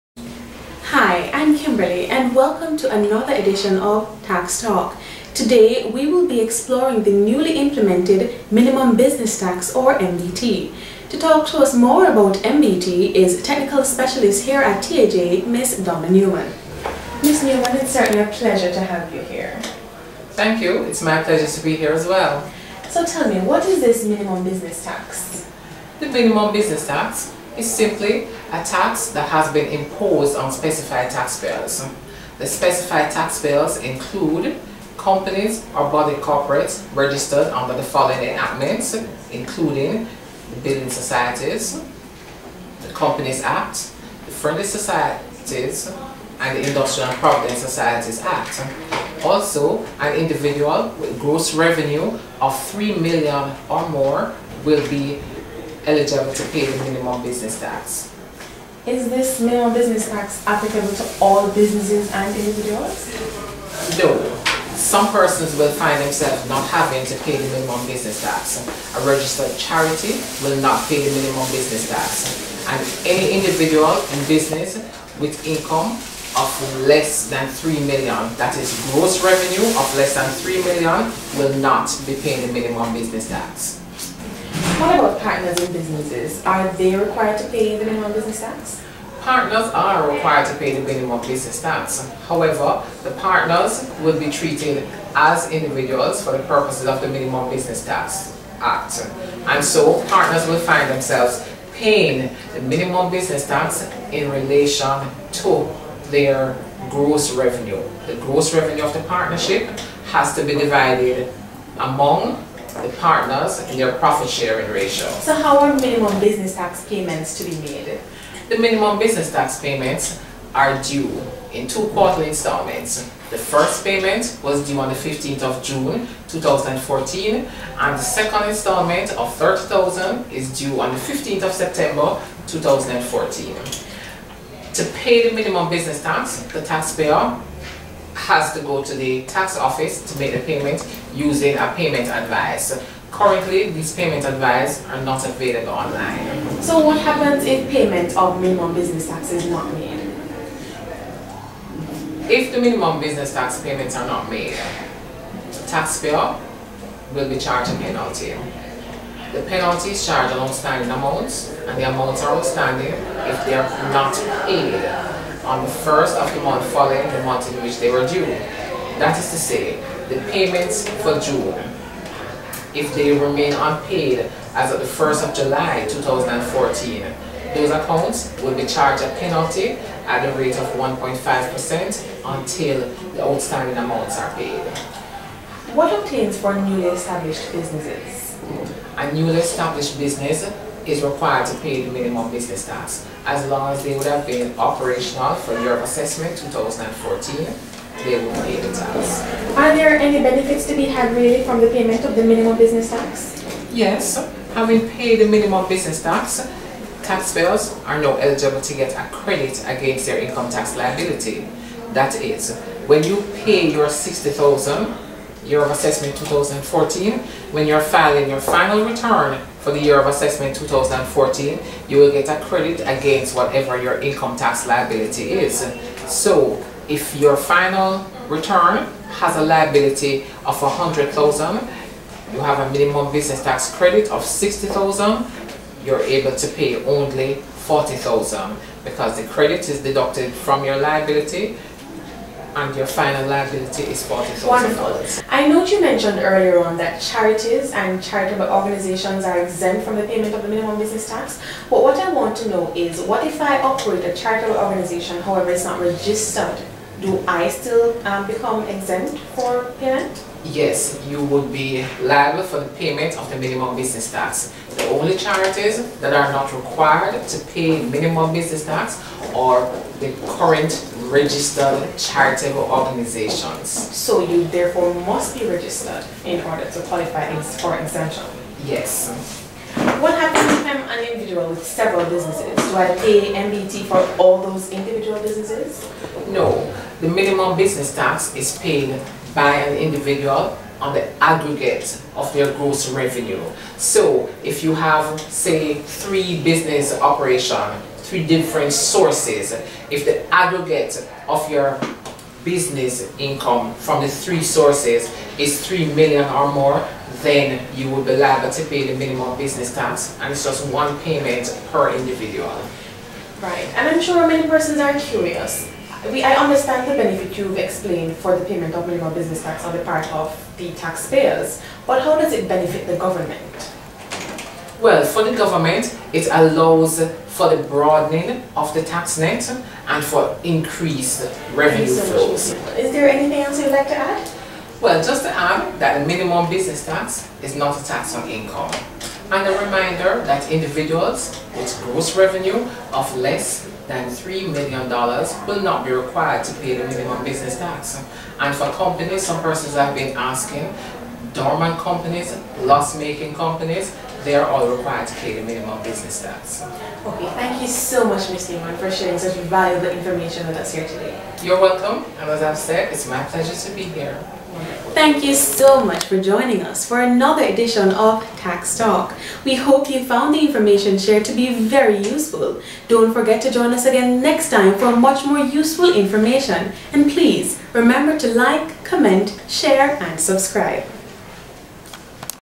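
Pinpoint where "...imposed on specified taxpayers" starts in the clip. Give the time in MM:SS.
00:29.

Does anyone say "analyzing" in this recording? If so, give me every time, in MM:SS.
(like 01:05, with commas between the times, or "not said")
not said.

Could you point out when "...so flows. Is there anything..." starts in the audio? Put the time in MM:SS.
05:31.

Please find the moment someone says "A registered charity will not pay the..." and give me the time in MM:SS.
01:08.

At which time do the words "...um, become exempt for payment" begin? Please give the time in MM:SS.
04:18.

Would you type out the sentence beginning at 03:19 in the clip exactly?
Are there any benefits to be had really from the payment of the minimum business tax?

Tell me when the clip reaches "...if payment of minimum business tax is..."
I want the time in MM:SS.
02:27.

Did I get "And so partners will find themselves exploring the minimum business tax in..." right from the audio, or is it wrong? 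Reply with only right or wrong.
wrong.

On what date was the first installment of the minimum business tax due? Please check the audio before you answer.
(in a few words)
15th of June 2014.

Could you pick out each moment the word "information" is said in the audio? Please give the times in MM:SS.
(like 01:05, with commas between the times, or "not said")
05:59, 06:10, 06:15.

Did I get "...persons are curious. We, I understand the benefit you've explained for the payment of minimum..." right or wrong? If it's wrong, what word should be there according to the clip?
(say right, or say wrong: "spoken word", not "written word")
right.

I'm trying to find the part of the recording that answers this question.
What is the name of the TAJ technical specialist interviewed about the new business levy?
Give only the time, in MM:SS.
00:15.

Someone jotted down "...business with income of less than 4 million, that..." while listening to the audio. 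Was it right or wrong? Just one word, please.
wrong.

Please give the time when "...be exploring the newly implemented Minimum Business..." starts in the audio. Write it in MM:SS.
00:06.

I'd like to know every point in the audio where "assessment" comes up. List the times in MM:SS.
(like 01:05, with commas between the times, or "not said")
03:15, 03:35, 03:40.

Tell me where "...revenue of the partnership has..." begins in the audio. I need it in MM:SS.
01:48.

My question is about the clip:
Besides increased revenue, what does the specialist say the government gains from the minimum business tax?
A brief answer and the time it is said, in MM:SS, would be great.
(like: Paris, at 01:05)
broadening of the tax net, at 05:27.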